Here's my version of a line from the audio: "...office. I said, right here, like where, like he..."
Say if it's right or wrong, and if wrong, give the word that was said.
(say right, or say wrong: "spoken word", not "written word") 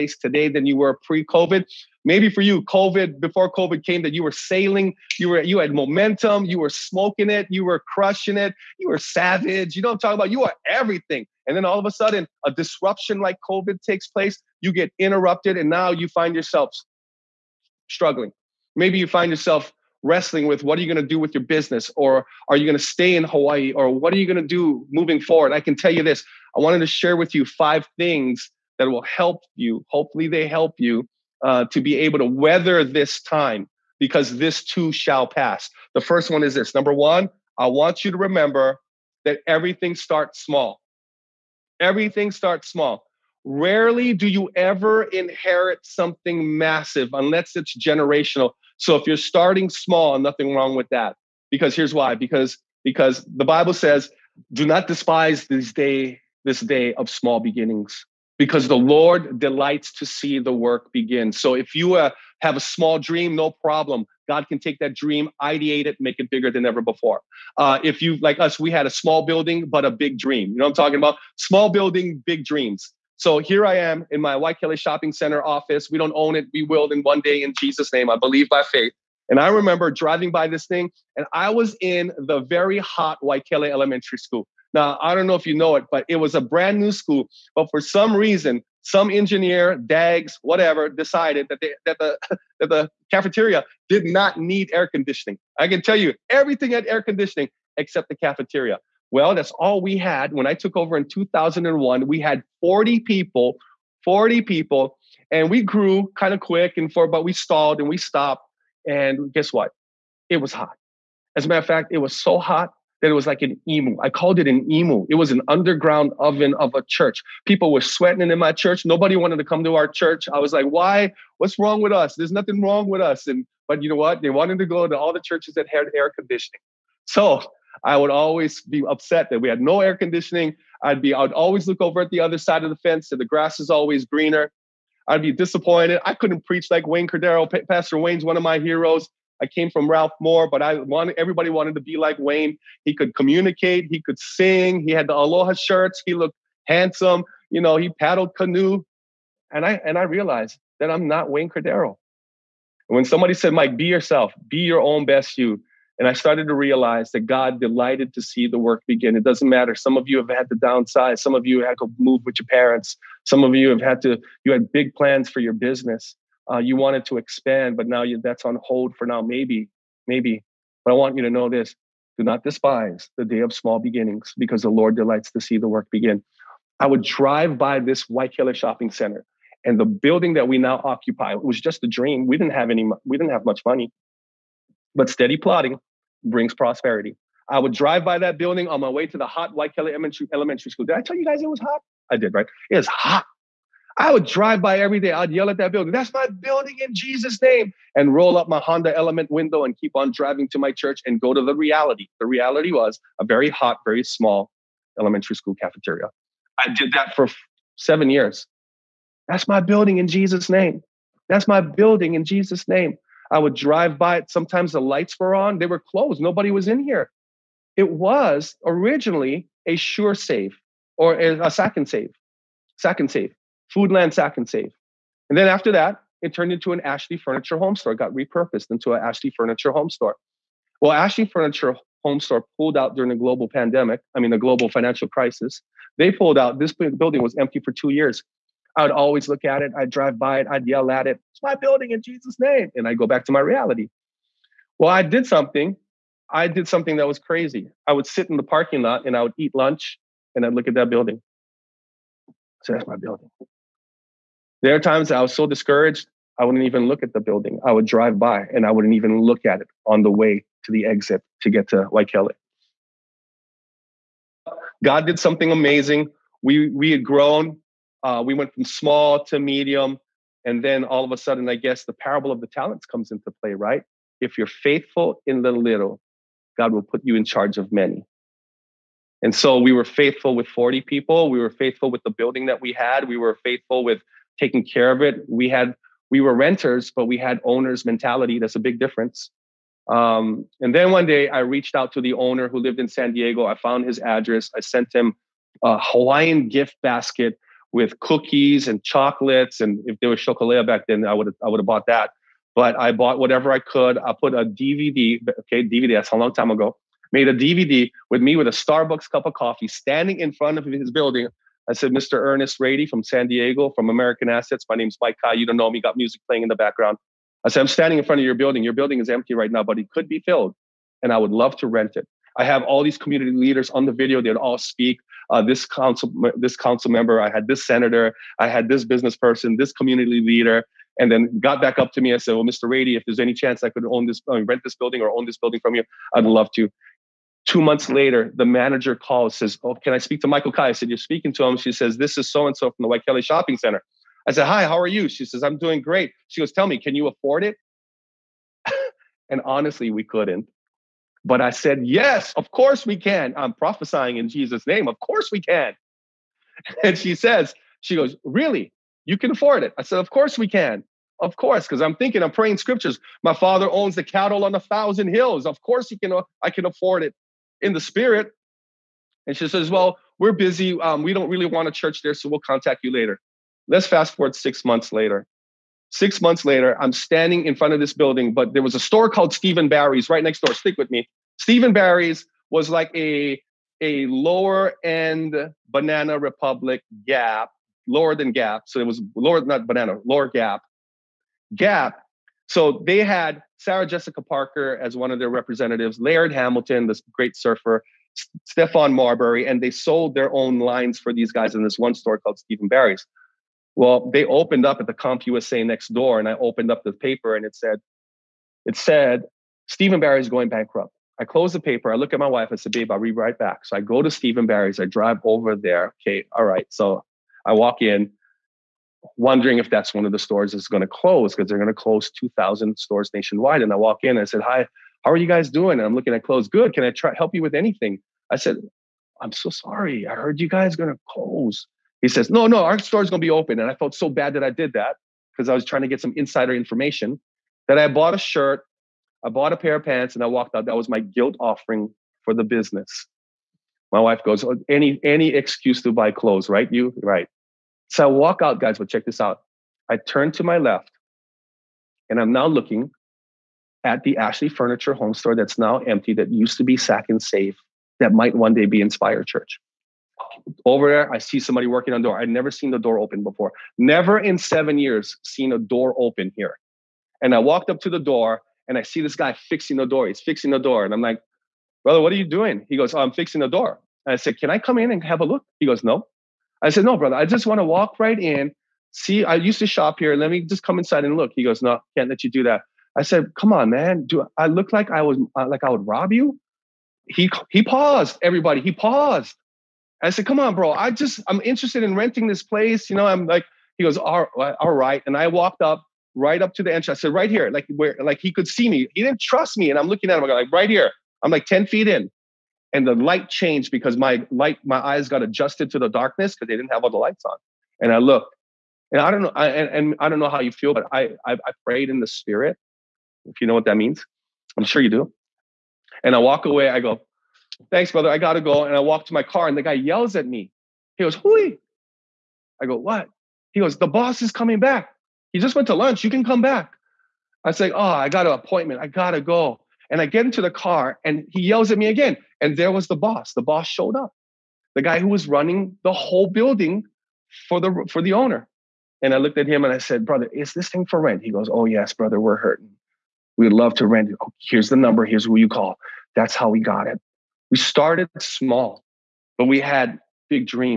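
wrong: "entrance", not "office".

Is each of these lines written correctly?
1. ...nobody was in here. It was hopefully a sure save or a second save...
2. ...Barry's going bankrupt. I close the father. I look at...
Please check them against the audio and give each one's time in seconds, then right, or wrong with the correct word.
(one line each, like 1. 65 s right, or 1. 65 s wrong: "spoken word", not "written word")
1. 216 s wrong: "originally", not "hopefully"
2. 409 s wrong: "paper", not "father".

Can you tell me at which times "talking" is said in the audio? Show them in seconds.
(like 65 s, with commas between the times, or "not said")
9 s, 70 s.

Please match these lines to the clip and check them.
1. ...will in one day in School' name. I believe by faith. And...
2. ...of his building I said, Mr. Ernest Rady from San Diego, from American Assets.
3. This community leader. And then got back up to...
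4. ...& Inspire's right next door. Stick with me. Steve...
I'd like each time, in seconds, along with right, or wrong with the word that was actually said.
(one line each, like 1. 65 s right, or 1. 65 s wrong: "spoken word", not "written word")
1. 76 s wrong: "Jesus", not "School"
2. 310 s right
3. 329 s right
4. 379 s wrong: "Barry", not "Inspire".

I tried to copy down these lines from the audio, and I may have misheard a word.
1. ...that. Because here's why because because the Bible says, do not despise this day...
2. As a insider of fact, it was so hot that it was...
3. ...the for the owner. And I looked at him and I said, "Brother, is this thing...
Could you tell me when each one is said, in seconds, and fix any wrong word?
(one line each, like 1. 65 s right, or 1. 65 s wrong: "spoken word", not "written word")
1. 50 s right
2. 111 s wrong: "matter", not "insider"
3. 537 s right.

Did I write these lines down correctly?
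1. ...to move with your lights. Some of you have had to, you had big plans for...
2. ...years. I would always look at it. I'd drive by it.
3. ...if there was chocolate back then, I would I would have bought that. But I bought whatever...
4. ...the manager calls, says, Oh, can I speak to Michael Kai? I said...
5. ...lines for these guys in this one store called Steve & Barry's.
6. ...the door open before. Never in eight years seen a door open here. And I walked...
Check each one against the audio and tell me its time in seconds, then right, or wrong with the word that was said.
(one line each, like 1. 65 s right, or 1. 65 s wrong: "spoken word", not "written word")
1. 161 s wrong: "parents", not "lights"
2. 237 s right
3. 299 s right
4. 338 s right
5. 400 s right
6. 462 s wrong: "seven", not "eight".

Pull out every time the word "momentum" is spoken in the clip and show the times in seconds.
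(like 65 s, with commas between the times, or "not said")
5 s.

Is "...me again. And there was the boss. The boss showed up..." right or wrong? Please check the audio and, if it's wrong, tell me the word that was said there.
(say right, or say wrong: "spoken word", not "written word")
right.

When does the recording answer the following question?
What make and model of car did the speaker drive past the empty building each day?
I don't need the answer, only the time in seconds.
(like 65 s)
198 s.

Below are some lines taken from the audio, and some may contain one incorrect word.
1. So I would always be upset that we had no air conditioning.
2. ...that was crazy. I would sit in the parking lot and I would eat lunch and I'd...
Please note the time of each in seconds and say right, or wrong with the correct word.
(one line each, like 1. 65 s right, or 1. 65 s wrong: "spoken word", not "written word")
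1. 127 s right
2. 246 s right.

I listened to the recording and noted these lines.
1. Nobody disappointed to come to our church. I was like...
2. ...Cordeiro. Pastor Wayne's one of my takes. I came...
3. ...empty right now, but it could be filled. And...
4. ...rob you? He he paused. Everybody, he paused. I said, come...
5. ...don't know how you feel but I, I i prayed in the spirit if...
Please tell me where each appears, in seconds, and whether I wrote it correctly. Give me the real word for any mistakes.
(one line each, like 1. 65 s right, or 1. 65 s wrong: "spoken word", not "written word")
1. 118 s wrong: "wanted", not "disappointed"
2. 137 s wrong: "heroes", not "takes"
3. 319 s right
4. 485 s right
5. 510 s right.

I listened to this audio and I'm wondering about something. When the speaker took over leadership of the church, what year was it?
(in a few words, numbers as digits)
2001.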